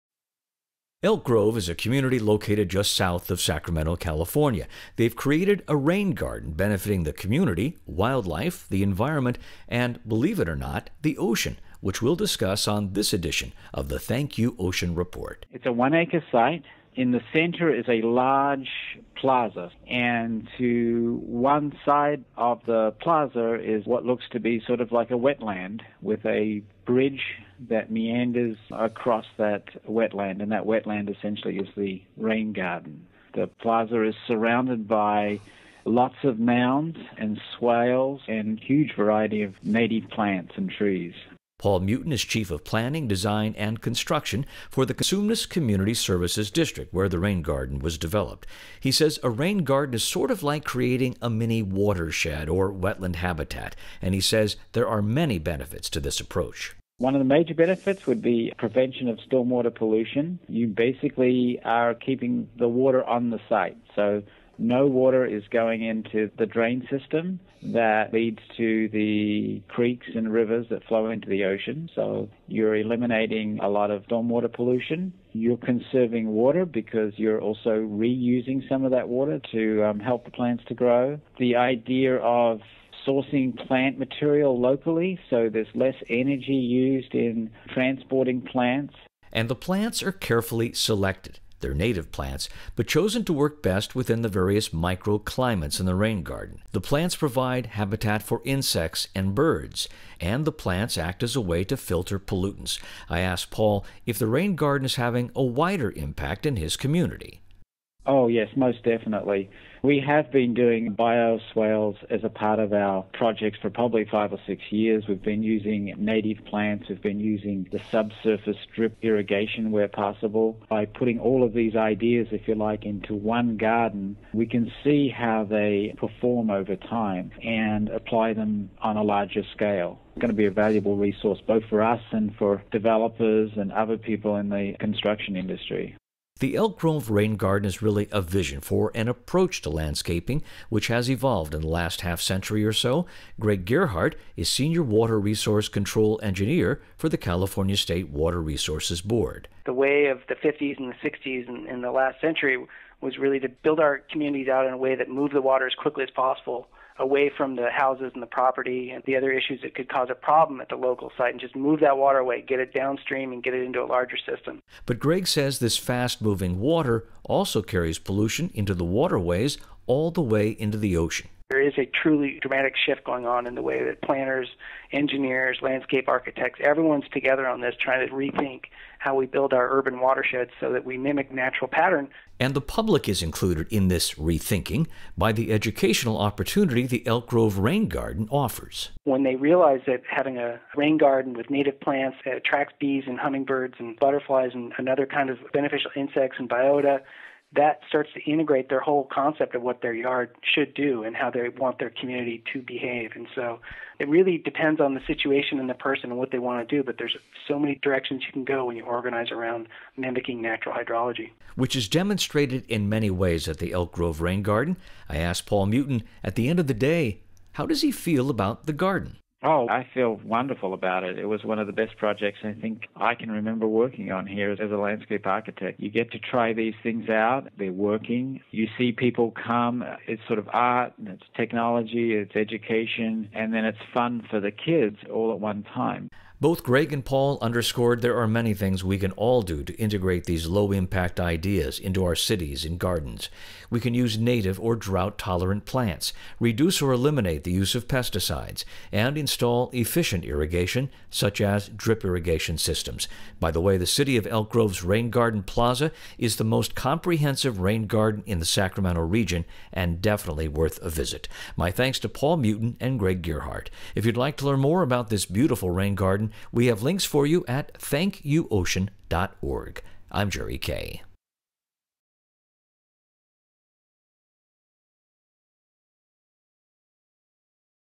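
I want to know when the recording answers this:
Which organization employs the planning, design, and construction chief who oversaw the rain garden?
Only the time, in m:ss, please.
0:44.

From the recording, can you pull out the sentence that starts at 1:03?
So no water is going into the drain system that leads to the creeks and rivers that flow into the ocean.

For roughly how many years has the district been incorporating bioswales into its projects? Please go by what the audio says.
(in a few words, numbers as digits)
5 or 6 years.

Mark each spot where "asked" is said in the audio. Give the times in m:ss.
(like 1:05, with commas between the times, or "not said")
1:43, 3:35.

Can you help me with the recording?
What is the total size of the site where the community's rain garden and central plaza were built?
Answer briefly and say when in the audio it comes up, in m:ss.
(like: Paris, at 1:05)
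1 acre, at 0:15.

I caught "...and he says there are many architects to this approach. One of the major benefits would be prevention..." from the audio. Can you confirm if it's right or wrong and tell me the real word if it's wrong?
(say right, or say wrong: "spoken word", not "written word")
wrong: "benefits", not "architects".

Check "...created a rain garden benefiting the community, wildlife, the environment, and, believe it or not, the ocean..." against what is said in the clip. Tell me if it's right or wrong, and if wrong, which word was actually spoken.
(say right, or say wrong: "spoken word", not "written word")
right.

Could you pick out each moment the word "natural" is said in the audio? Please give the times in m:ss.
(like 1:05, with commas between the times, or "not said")
3:01, 3:30.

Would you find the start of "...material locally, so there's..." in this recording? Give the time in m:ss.
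1:23.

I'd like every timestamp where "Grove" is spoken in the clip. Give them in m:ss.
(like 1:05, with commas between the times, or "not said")
0:01, 2:16, 3:07, 3:33, 4:14.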